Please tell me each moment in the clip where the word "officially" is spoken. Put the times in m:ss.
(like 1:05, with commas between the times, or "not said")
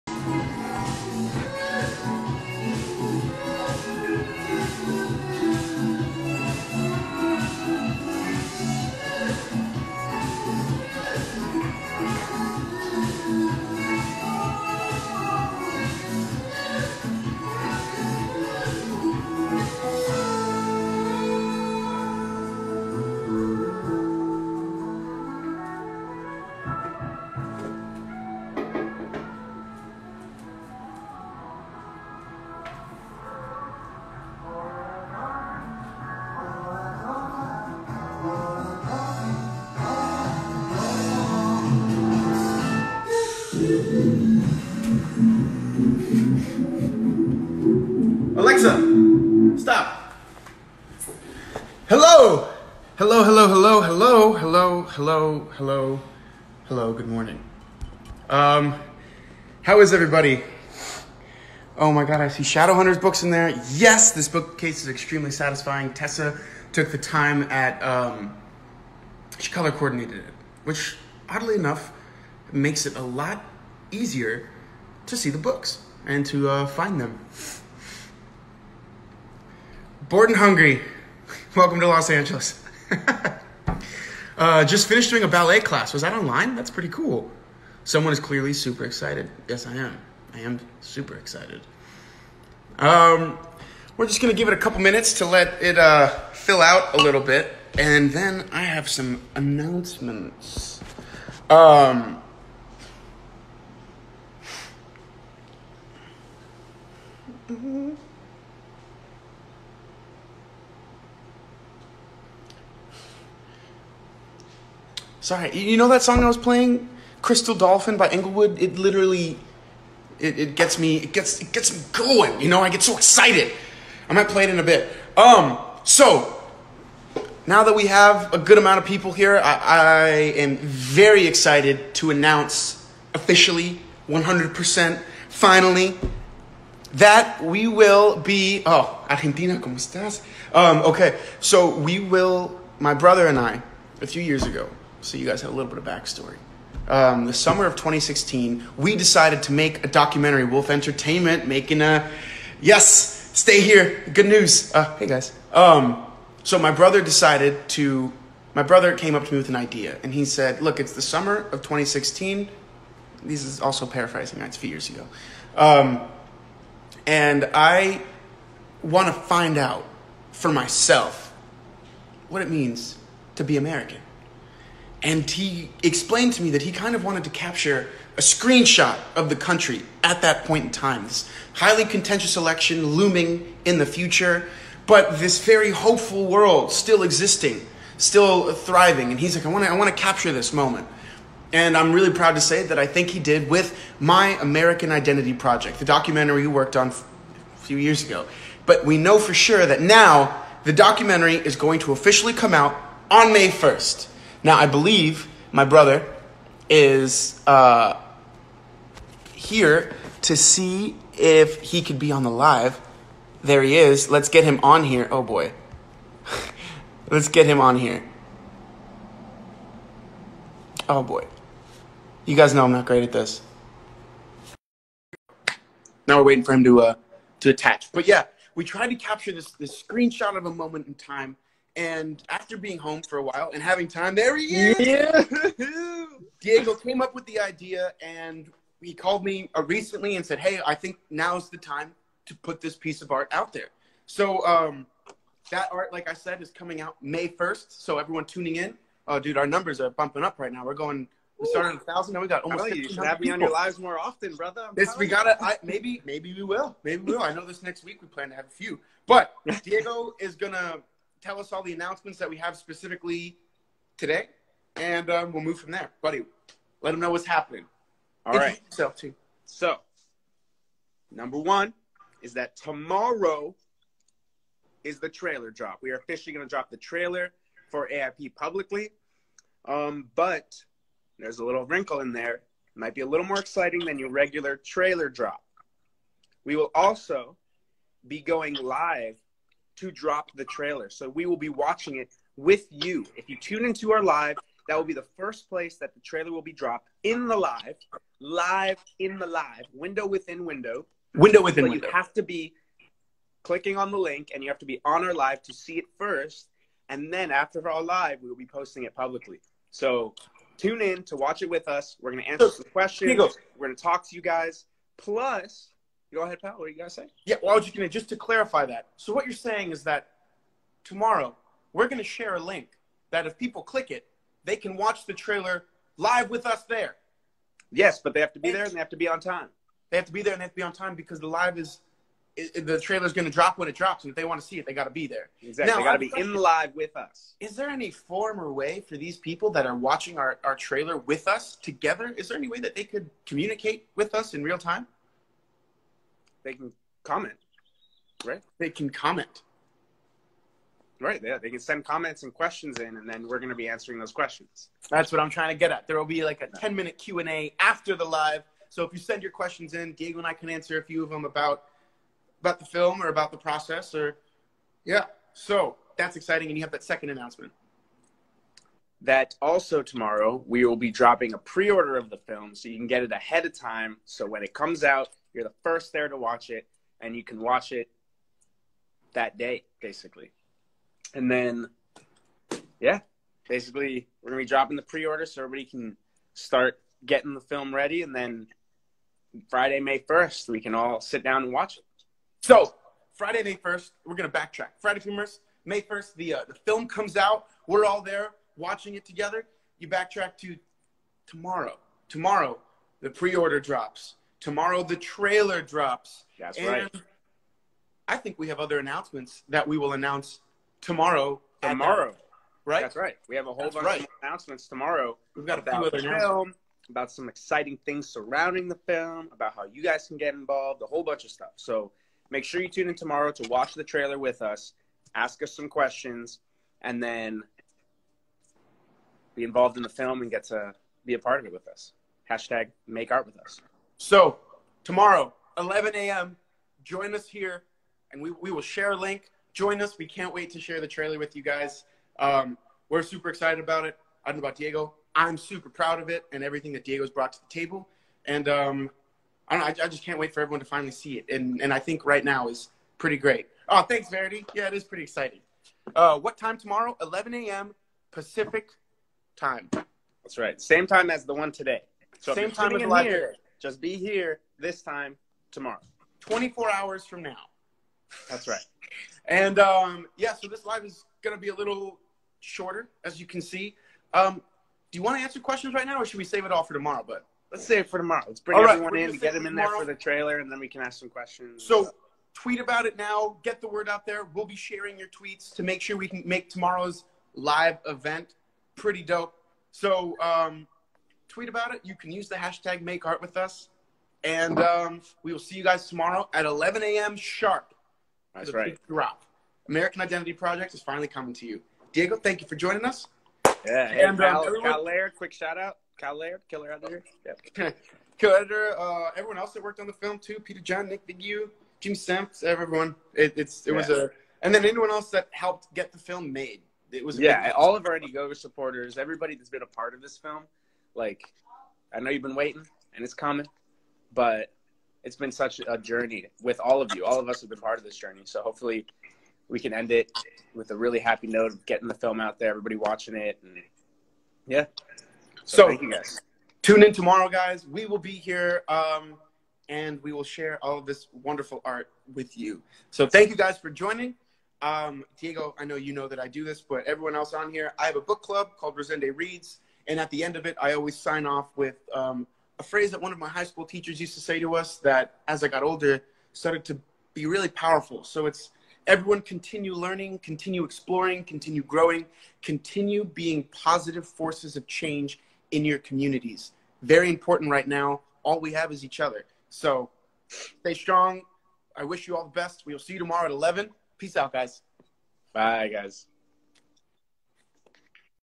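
2:13, 3:21, 4:35.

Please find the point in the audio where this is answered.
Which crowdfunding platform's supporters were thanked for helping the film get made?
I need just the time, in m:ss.
8:37.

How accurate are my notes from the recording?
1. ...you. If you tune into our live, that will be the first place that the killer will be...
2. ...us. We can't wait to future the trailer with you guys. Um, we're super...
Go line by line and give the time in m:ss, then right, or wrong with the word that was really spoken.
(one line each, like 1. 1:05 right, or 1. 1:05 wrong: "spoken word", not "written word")
1. 4:52 wrong: "trailer", not "killer"
2. 7:19 wrong: "share", not "future".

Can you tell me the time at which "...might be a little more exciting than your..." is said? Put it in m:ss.
4:42.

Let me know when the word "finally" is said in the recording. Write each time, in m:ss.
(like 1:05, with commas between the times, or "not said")
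2:15, 7:30, 8:20.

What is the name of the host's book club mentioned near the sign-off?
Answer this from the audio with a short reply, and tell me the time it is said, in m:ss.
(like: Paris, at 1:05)
Rosende Reads, at 9:08.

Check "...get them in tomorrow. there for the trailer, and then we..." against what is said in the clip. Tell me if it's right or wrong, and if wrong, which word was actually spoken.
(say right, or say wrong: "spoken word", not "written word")
right.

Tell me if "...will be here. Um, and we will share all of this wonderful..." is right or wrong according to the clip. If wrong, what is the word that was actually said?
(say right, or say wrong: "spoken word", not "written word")
right.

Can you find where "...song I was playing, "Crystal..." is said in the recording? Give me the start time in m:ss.
1:56.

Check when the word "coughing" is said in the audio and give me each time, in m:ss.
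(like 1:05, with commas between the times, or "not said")
not said.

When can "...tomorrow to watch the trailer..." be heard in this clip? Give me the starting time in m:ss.
7:02.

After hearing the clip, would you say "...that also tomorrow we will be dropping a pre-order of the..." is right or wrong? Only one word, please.
right.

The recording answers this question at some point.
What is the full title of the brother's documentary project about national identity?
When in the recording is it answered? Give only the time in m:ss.
3:13.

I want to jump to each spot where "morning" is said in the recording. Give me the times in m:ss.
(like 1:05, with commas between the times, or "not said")
0:57.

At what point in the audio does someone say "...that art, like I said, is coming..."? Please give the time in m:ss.
4:05.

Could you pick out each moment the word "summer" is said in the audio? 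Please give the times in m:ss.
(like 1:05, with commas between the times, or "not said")
2:27, 2:41.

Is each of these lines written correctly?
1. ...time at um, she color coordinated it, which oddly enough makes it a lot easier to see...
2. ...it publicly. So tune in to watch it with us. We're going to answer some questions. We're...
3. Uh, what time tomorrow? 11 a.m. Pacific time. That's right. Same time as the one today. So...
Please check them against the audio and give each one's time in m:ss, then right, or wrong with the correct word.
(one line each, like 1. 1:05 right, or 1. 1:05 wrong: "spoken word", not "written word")
1. 1:06 right
2. 5:08 right
3. 7:35 right.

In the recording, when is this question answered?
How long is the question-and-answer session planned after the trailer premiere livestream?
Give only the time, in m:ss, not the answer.
5:56.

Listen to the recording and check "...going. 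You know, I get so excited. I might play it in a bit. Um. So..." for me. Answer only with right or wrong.
right.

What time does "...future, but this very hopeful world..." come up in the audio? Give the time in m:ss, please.
3:03.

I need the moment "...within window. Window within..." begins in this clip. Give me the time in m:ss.
5:00.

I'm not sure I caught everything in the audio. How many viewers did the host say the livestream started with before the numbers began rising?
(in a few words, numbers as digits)
1000.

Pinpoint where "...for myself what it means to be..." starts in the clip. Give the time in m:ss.
2:50.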